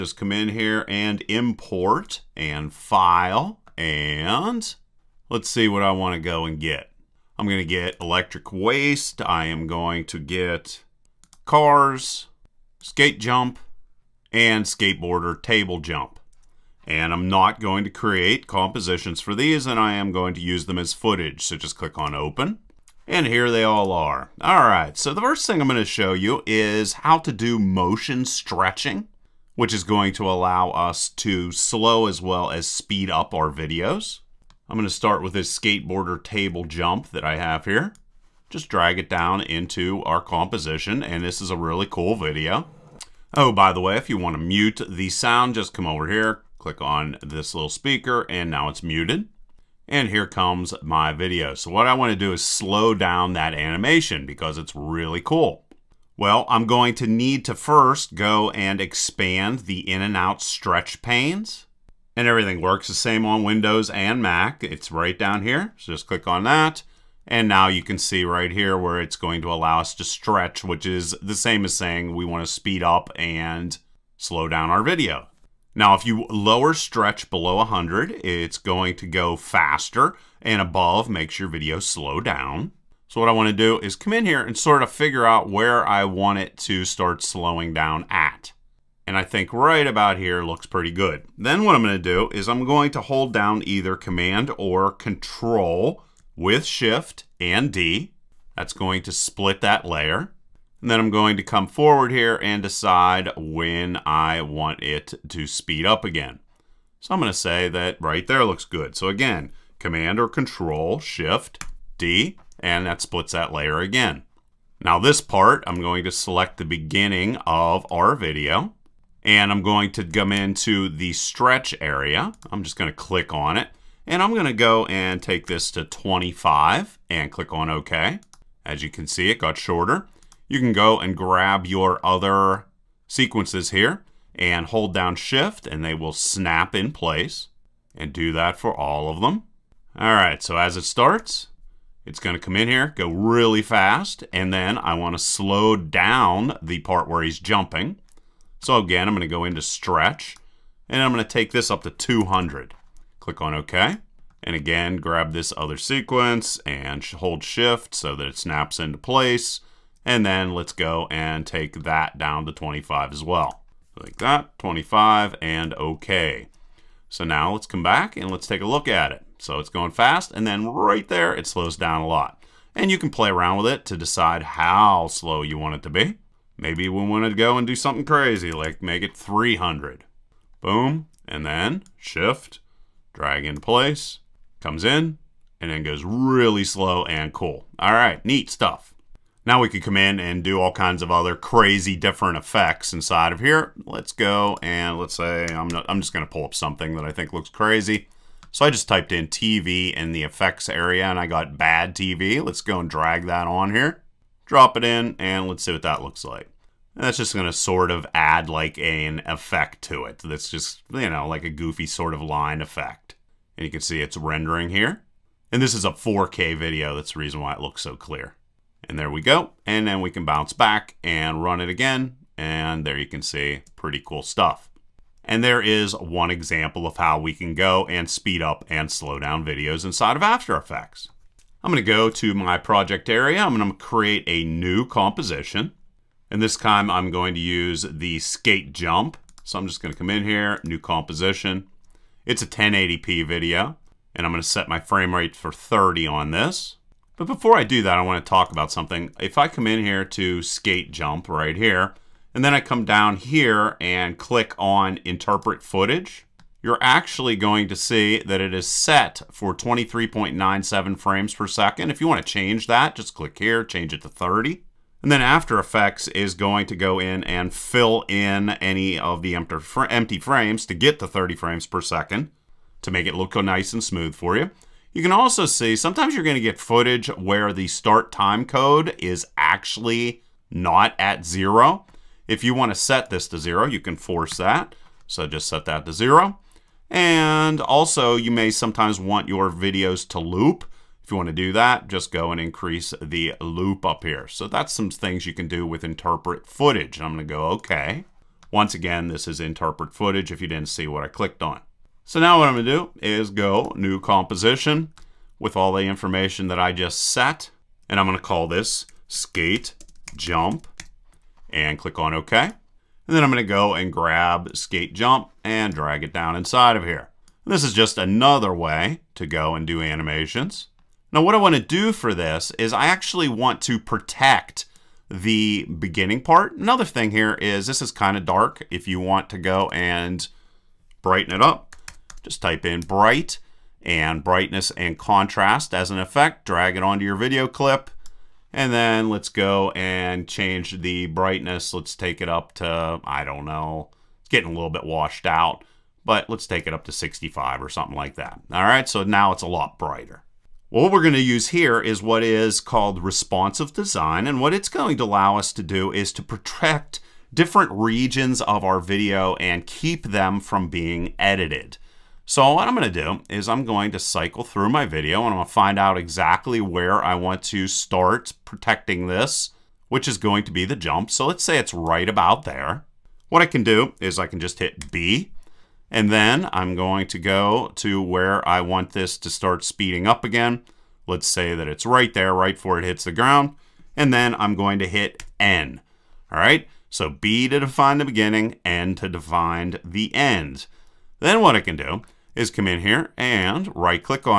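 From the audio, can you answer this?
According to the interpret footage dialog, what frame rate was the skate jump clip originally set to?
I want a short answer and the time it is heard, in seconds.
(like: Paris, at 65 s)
23.97, at 259 s.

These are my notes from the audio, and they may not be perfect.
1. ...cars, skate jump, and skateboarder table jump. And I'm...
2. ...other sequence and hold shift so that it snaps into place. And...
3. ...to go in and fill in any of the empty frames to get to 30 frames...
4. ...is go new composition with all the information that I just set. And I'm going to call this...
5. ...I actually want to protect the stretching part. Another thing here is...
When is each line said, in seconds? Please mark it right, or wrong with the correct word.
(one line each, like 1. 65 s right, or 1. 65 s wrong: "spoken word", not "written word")
1. 11 s right
2. 155 s right
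3. 266 s right
4. 303 s right
5. 322 s wrong: "beginning", not "stretching".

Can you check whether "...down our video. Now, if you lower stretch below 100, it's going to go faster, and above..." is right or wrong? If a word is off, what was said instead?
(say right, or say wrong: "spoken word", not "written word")
right.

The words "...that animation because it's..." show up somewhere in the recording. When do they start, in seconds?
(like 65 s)
53 s.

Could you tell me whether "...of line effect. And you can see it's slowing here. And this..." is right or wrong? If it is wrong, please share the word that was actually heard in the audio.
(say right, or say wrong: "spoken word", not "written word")
wrong: "rendering", not "slowing".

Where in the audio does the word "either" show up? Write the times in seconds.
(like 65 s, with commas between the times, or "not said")
93 s.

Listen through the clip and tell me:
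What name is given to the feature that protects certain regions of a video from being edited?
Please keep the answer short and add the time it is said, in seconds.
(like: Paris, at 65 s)
responsive design, at 353 s.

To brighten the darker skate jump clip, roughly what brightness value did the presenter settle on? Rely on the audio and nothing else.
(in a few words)
65.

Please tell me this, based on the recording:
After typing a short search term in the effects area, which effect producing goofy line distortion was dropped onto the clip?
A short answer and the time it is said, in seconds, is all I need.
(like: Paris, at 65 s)
bad TV, at 201 s.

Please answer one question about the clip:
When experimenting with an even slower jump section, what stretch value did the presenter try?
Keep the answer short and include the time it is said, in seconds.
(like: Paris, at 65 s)
300, at 179 s.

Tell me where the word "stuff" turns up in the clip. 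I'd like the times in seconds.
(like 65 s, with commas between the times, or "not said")
188 s, 224 s.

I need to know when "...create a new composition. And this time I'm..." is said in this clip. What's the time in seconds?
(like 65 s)
233 s.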